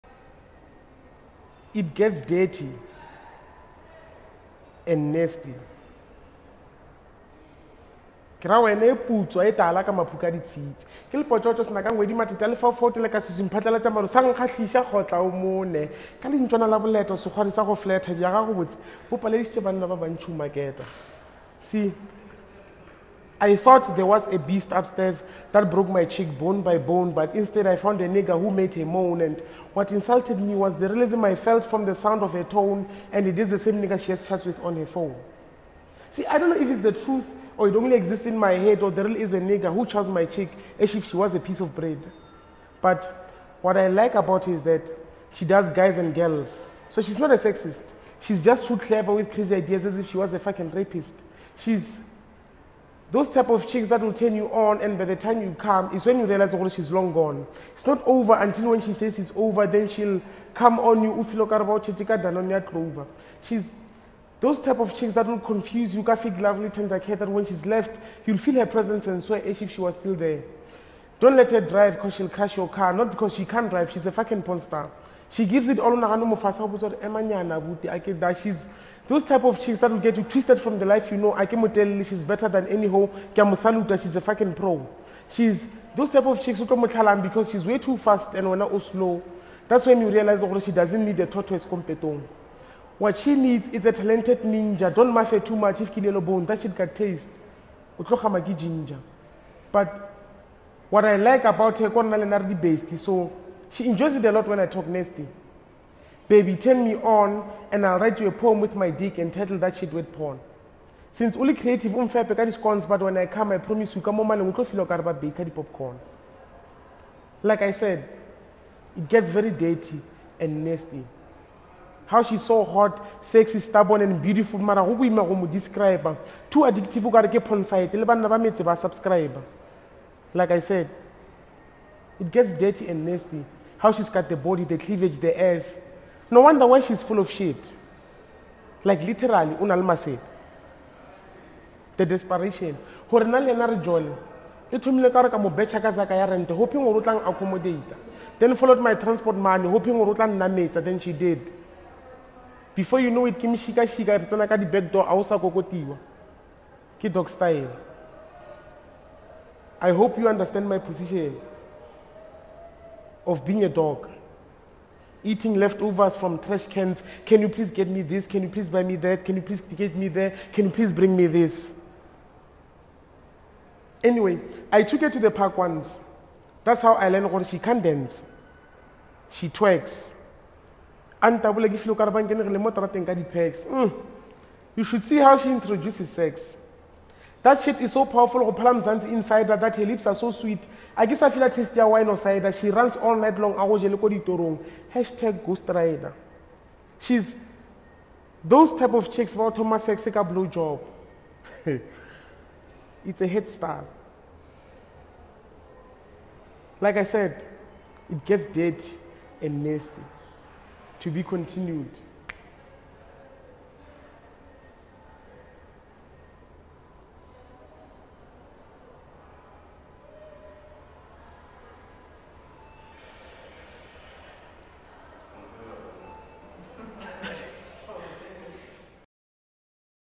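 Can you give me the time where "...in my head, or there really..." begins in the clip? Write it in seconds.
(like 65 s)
38 s.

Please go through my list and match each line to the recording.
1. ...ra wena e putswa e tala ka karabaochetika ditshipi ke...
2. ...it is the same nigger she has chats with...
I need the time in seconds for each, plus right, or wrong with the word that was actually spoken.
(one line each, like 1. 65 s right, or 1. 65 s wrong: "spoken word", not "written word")
1. 8 s wrong: "maphuka", not "karabaochetika"
2. 33 s right.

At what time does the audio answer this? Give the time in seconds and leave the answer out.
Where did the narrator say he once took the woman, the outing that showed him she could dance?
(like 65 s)
175 s.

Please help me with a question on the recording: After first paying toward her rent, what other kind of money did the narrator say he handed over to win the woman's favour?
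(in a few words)
transport money.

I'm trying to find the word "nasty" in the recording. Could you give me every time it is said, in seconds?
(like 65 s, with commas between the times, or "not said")
5 s, 104 s, 120 s, 133 s, 209 s.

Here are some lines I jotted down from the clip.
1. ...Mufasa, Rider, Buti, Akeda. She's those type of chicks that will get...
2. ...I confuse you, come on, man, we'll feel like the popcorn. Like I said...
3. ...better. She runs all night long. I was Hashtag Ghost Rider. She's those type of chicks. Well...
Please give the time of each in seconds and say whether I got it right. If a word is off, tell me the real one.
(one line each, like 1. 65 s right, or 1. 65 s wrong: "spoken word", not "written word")
1. 76 s wrong: "Emanyana", not "Rider"
2. 113 s wrong: "promise", not "confuse"
3. 192 s wrong: "cider", not "better".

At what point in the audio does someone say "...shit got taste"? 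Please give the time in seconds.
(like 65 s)
96 s.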